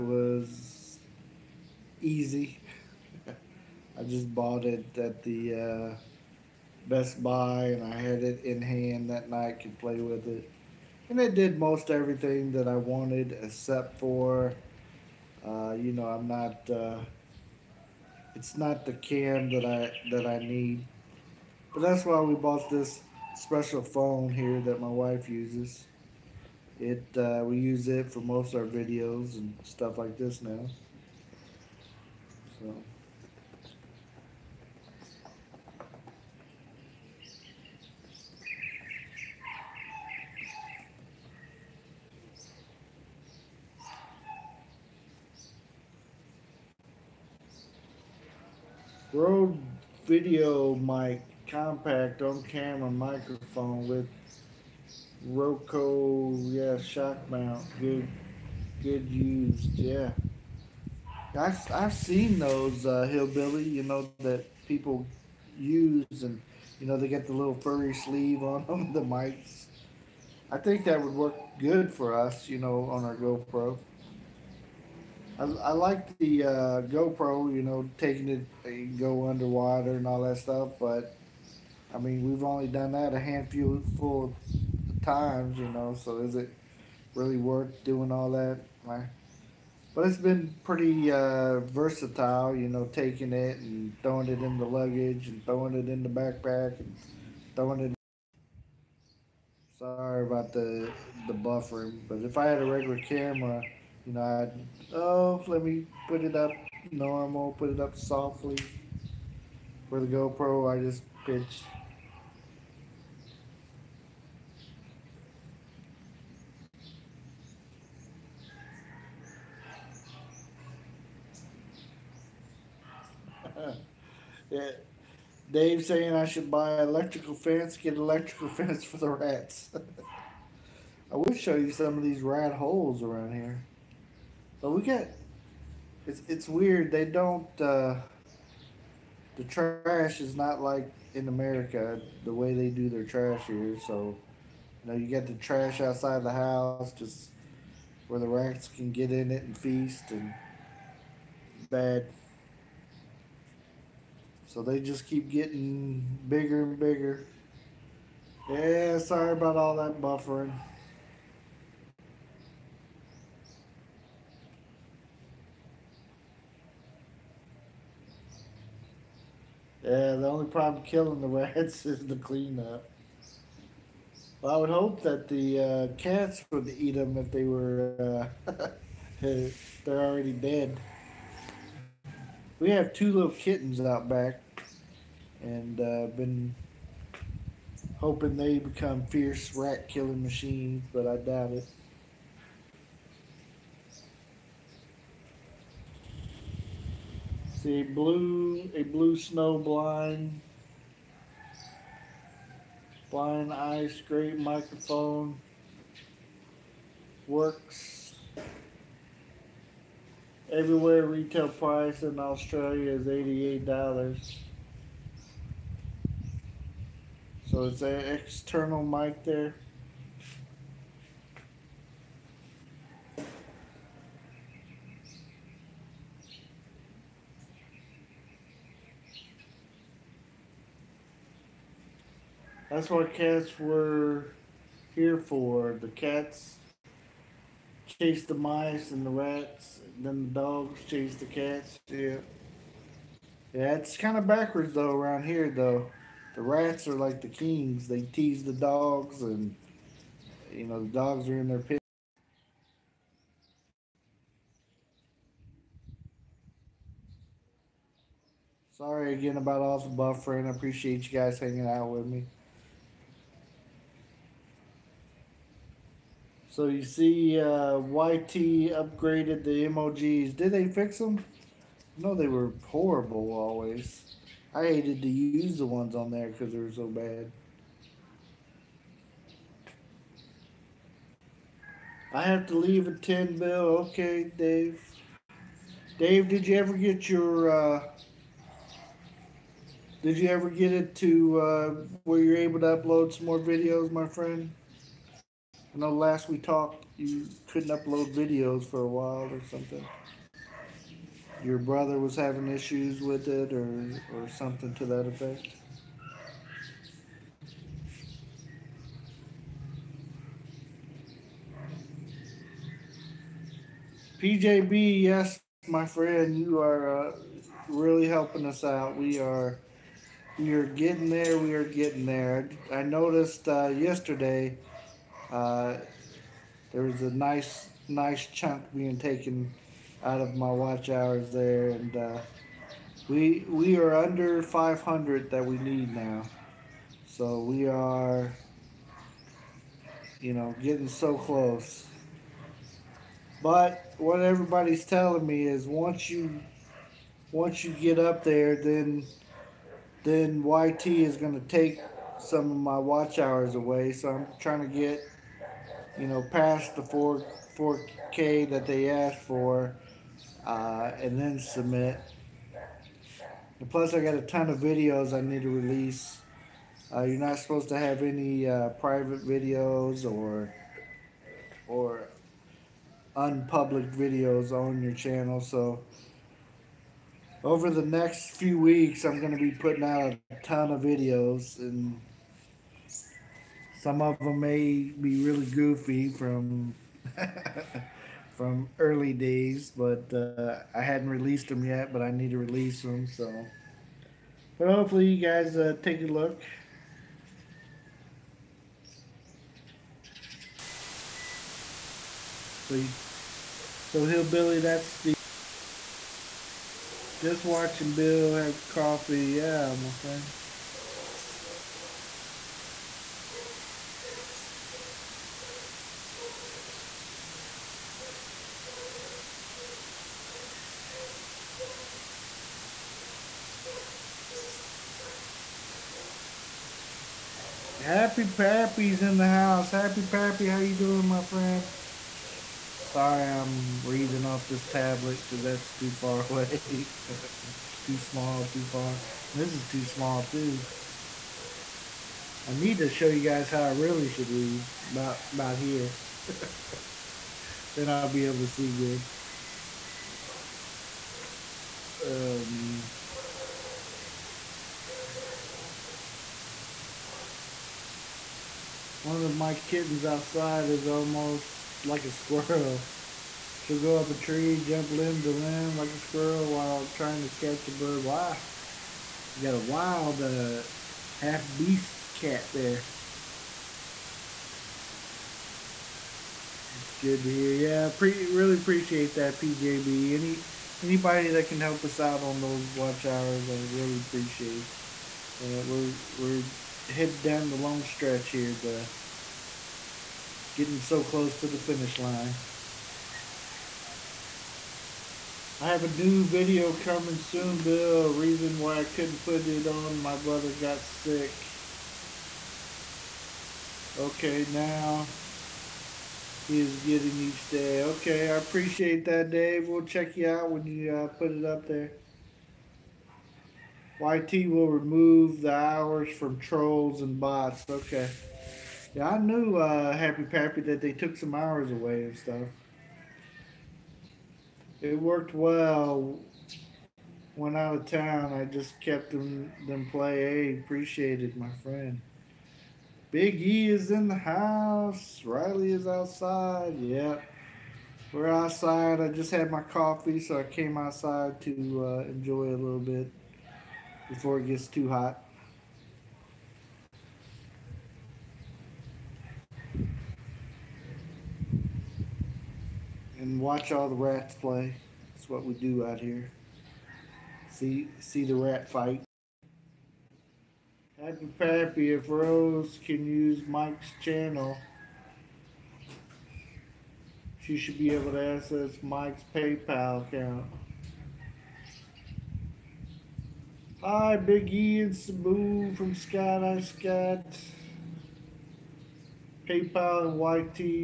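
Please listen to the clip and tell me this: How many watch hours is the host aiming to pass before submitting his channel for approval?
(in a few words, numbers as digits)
4K.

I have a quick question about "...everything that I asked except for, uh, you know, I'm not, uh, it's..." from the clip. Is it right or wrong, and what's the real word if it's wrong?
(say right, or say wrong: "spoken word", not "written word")
wrong: "wanted", not "asked".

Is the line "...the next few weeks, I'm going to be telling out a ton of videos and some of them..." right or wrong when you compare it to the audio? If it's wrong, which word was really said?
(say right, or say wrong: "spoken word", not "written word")
wrong: "putting", not "telling".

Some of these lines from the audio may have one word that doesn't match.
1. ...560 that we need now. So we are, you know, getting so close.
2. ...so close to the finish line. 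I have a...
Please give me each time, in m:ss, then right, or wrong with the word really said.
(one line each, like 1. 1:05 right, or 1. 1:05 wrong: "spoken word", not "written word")
1. 5:34 wrong: "500", not "560"
2. 8:10 right.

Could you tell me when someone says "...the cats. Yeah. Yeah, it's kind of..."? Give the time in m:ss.
4:01.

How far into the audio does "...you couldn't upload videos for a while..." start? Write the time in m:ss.
4:56.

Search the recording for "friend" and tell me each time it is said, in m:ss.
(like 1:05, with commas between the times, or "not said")
4:54, 5:15, 6:49, 7:11, 8:51.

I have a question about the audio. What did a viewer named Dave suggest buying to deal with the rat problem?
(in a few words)
electrical fence.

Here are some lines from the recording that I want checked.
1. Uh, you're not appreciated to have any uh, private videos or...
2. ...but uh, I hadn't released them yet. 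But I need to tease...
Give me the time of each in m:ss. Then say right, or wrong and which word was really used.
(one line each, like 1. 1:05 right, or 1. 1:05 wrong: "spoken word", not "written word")
1. 6:06 wrong: "supposed", not "appreciated"
2. 6:29 wrong: "release", not "tease".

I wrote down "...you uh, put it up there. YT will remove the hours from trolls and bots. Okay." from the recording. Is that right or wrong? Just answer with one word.
right.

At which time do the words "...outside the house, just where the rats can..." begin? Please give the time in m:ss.
2:25.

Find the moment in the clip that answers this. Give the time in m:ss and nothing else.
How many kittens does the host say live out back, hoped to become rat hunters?
3:02.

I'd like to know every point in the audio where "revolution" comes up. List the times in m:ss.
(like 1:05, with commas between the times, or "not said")
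not said.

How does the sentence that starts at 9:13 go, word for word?
And watch all the rats play.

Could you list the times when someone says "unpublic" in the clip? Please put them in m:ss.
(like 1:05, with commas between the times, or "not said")
6:13.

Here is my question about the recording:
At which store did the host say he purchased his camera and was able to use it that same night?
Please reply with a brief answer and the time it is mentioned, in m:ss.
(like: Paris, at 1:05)
Best Buy, at 0:06.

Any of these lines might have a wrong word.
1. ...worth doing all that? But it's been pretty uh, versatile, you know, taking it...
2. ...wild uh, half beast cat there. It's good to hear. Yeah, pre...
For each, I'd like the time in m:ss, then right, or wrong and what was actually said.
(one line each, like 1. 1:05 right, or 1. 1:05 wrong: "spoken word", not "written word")
1. 1:27 right
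2. 7:49 right.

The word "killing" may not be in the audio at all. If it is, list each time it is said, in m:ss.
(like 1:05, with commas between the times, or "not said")
2:50, 3:09.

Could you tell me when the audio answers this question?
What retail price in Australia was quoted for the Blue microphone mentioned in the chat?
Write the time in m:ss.
3:33.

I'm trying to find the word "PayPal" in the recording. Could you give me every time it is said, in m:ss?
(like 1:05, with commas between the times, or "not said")
9:29, 9:39.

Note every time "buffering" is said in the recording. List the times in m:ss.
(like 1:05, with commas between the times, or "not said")
1:41, 2:40, 4:19.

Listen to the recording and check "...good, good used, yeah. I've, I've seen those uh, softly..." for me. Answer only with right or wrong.
wrong.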